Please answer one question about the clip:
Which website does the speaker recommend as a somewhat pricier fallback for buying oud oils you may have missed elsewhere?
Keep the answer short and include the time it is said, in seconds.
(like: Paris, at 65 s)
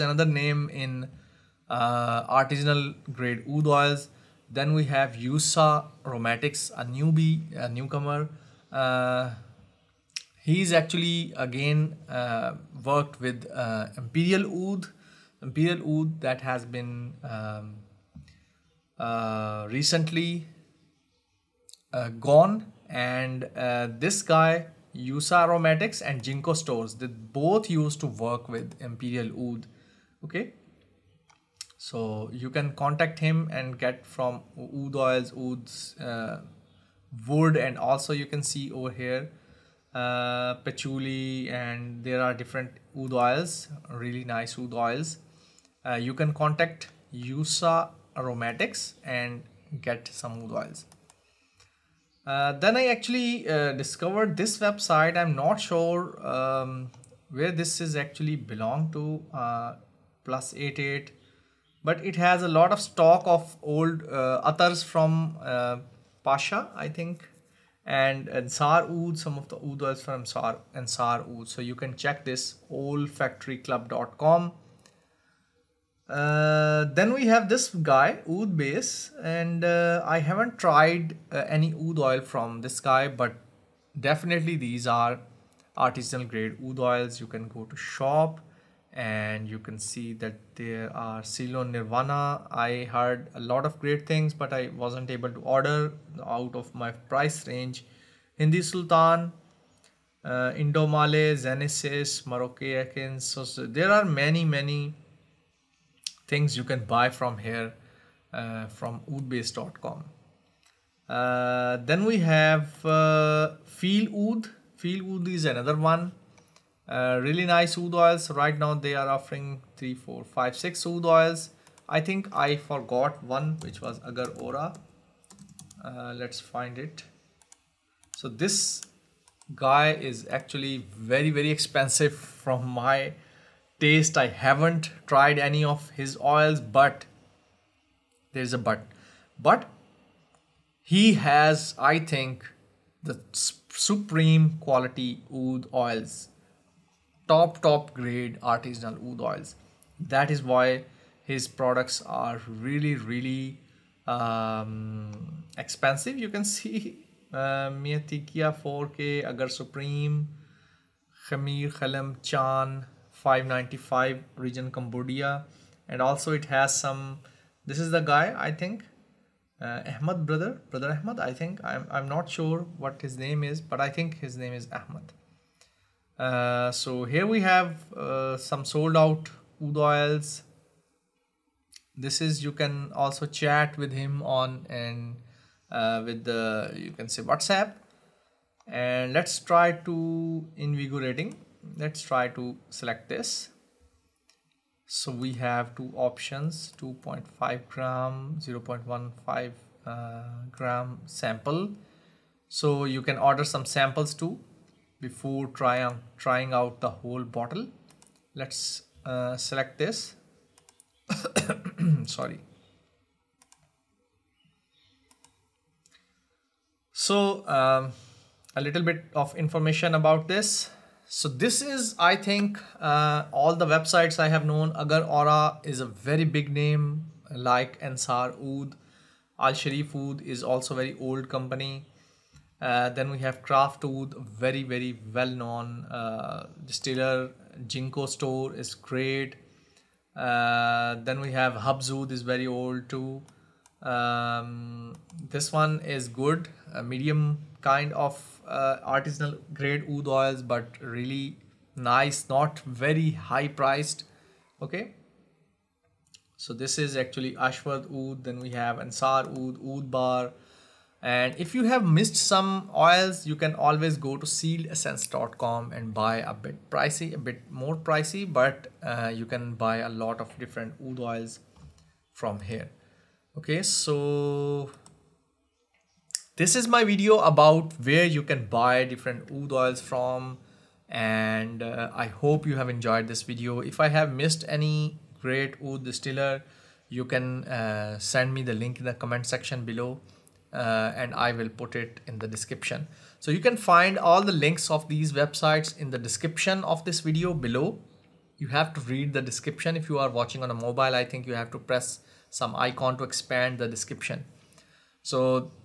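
sealedessence.com, at 264 s.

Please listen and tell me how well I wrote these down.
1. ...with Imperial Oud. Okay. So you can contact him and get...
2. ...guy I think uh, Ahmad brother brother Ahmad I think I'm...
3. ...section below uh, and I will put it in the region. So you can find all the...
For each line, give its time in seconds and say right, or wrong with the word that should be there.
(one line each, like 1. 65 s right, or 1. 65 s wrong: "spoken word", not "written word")
1. 28 s right
2. 168 s right
3. 289 s wrong: "description", not "region".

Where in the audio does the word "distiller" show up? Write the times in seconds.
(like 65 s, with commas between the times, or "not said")
236 s, 285 s.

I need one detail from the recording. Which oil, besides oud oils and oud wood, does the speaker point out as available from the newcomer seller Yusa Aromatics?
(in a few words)
patchouli.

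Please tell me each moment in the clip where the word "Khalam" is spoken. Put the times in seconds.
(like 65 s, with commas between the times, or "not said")
161 s.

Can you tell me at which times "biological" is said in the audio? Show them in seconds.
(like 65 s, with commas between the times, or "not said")
not said.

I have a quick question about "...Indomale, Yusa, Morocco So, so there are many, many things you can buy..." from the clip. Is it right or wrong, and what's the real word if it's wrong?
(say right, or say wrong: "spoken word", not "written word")
wrong: "Genesis", not "Yusa".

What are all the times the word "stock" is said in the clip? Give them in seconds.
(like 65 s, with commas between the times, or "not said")
62 s.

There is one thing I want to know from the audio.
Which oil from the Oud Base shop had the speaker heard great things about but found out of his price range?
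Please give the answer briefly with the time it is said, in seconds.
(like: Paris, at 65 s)
Ceylon Nirvana, at 91 s.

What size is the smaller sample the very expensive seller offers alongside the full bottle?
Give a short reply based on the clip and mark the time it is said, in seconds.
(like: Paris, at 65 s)
0.15 gram, at 198 s.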